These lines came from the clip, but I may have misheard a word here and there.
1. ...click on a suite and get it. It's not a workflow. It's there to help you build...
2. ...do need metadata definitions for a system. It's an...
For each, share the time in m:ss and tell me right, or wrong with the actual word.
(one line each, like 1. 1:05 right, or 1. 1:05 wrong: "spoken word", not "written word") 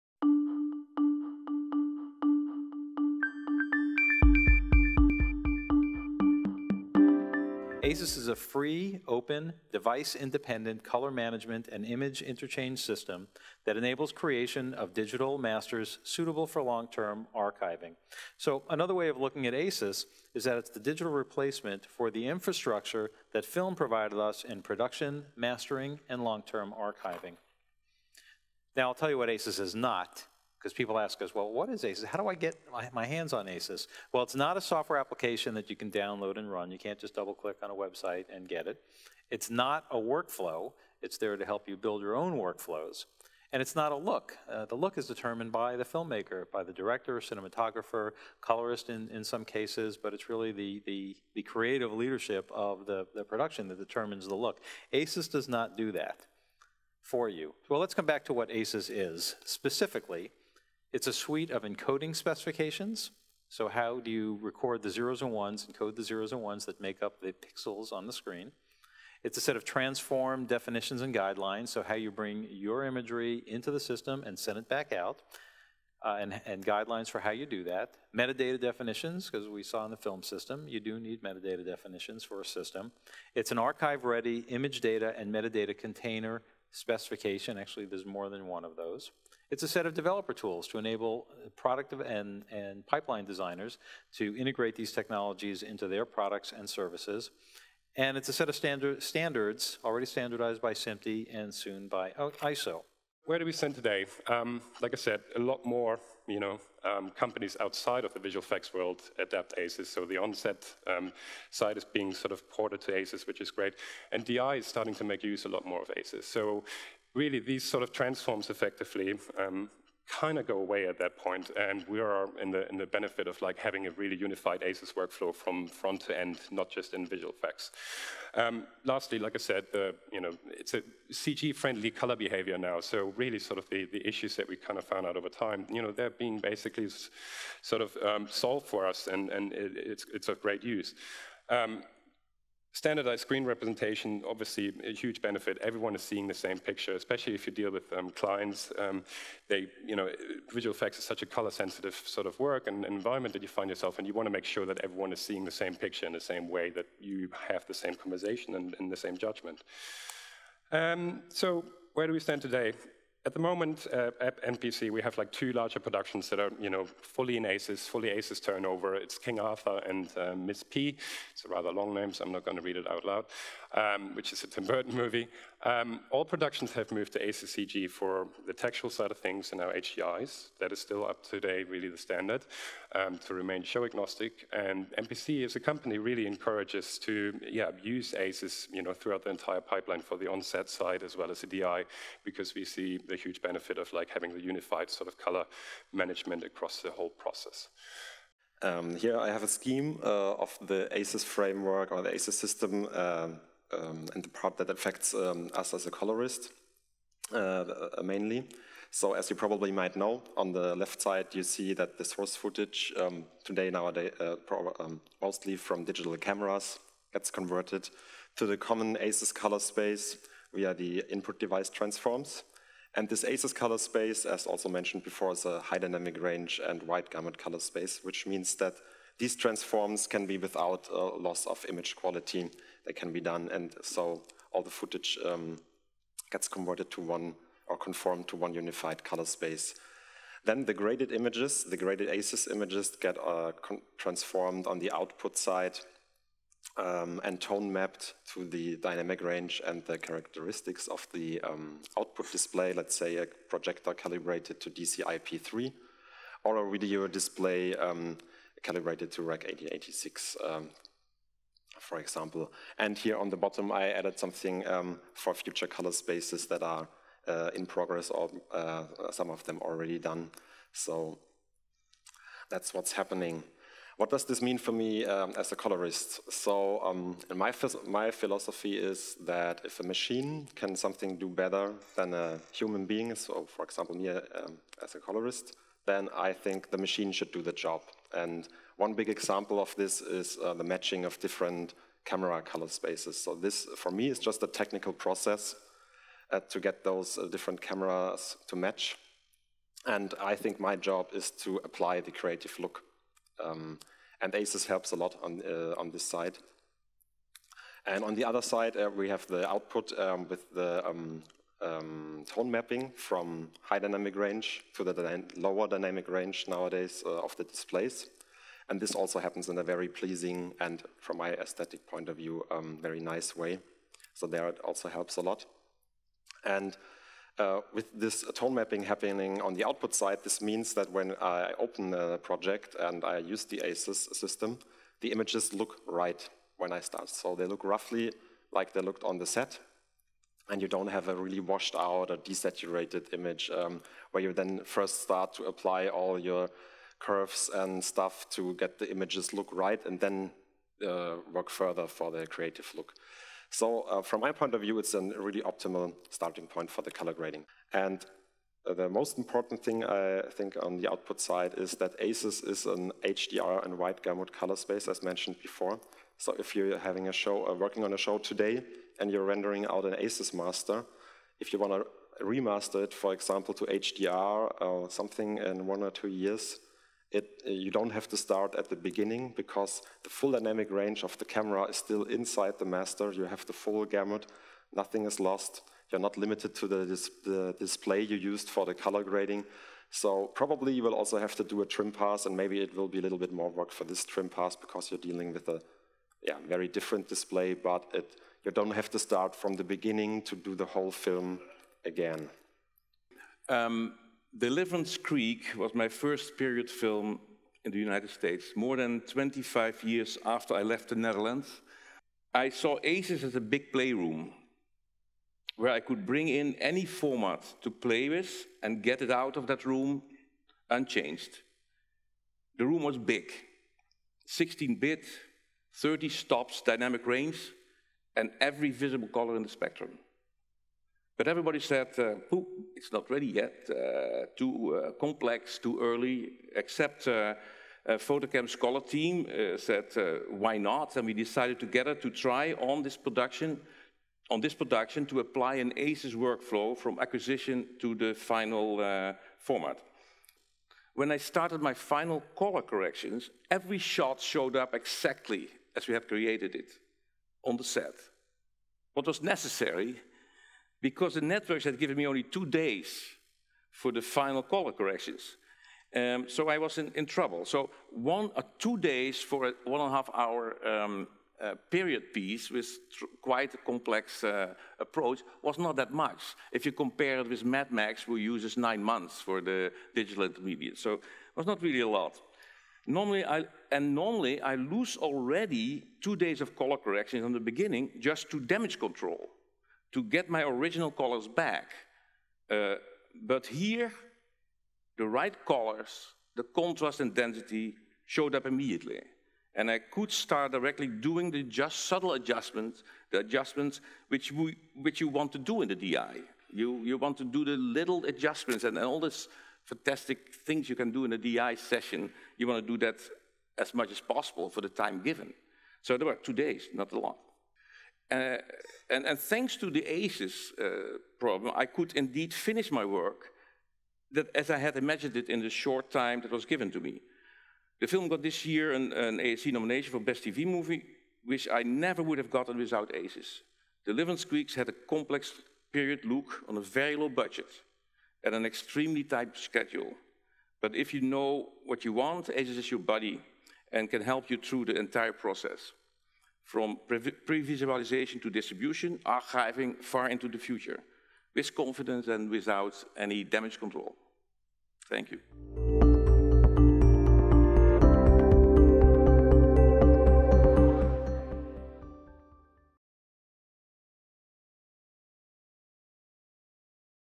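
1. 0:37 wrong: "website", not "suite"
2. 1:20 right.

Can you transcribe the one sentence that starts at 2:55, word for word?
Um, all productions have moved to ACEScg for the textual side of things and now HDIs.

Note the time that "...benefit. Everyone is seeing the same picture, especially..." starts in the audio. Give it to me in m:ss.
2:25.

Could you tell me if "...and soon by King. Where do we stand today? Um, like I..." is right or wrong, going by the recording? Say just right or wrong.
wrong.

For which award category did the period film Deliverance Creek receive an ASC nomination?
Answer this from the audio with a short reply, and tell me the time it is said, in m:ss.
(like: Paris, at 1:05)
Best TV Movie, at 8:50.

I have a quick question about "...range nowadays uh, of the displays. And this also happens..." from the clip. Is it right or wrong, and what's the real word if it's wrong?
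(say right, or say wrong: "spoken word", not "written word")
right.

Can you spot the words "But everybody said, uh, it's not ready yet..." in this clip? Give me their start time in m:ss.
7:11.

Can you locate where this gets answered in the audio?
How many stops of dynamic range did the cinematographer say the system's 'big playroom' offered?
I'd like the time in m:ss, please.
7:05.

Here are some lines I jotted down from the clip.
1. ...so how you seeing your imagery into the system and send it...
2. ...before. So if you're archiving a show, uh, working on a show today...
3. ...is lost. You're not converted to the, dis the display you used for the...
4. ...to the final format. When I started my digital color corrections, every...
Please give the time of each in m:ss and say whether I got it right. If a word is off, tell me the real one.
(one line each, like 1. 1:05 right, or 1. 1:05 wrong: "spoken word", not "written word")
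1. 1:11 wrong: "bring", not "seeing"
2. 6:05 wrong: "having", not "archiving"
3. 6:25 wrong: "limited", not "converted"
4. 7:27 wrong: "final", not "digital".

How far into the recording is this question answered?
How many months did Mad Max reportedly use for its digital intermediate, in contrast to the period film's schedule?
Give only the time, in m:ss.
7:58.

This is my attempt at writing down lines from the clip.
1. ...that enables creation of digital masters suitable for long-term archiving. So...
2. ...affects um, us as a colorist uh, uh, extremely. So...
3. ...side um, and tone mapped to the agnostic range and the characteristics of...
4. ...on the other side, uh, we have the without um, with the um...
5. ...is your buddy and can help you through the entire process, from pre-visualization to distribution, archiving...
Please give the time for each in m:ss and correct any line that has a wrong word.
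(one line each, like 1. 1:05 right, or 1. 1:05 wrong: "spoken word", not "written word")
1. 0:13 right
2. 3:24 wrong: "mainly", not "extremely"
3. 4:05 wrong: "dynamic", not "agnostic"
4. 5:08 wrong: "output", not "without"
5. 9:02 right.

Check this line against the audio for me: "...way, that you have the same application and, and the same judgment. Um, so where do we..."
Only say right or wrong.
wrong.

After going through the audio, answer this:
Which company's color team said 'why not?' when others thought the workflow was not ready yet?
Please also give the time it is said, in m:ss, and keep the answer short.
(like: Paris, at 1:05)
FotoKem, at 7:17.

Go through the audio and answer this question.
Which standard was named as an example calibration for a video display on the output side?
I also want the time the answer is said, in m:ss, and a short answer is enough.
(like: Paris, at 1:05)
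Rec 1886, at 4:19.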